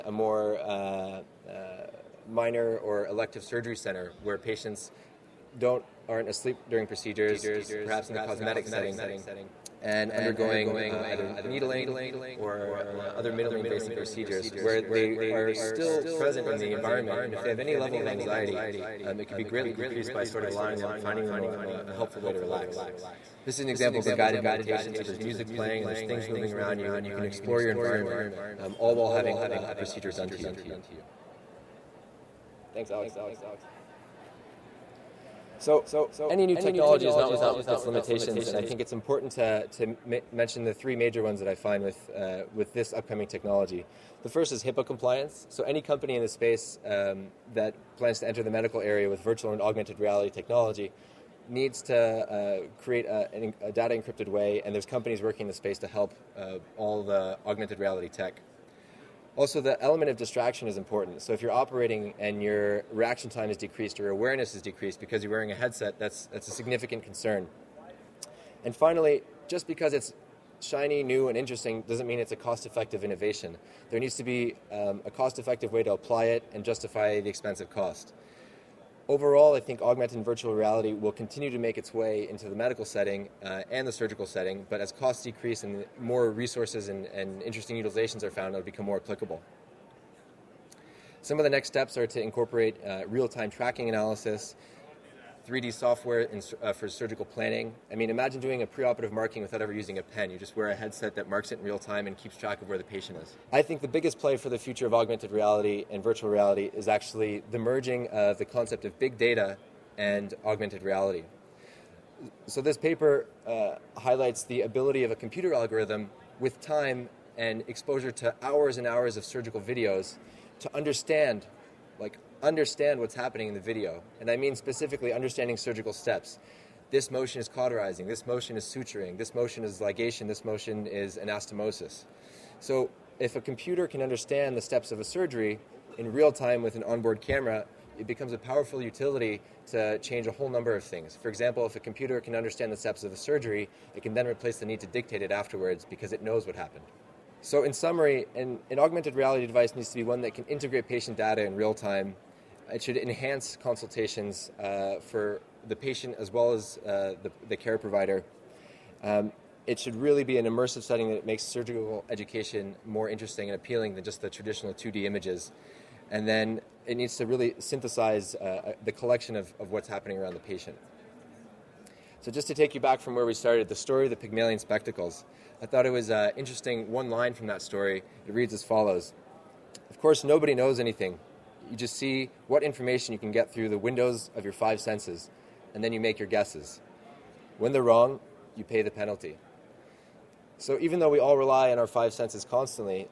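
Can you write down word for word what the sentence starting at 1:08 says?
And finally, just because it's shiny, new, and interesting doesn't mean it's a cost effective innovation.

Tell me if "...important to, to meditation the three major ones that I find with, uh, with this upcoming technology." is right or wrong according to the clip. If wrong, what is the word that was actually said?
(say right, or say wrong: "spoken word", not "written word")
wrong: "mention", not "meditation".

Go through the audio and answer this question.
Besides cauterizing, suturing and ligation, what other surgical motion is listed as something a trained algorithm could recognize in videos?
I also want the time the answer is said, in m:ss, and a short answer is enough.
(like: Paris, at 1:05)
Anastomosis, at 2:11.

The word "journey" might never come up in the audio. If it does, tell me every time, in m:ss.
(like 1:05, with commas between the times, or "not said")
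not said.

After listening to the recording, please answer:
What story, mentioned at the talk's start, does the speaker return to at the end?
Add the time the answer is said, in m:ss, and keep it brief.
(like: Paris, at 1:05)
The Pygmalion spectacles, at 2:54.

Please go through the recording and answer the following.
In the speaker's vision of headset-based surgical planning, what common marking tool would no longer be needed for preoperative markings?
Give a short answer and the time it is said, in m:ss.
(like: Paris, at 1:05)
A pen, at 1:39.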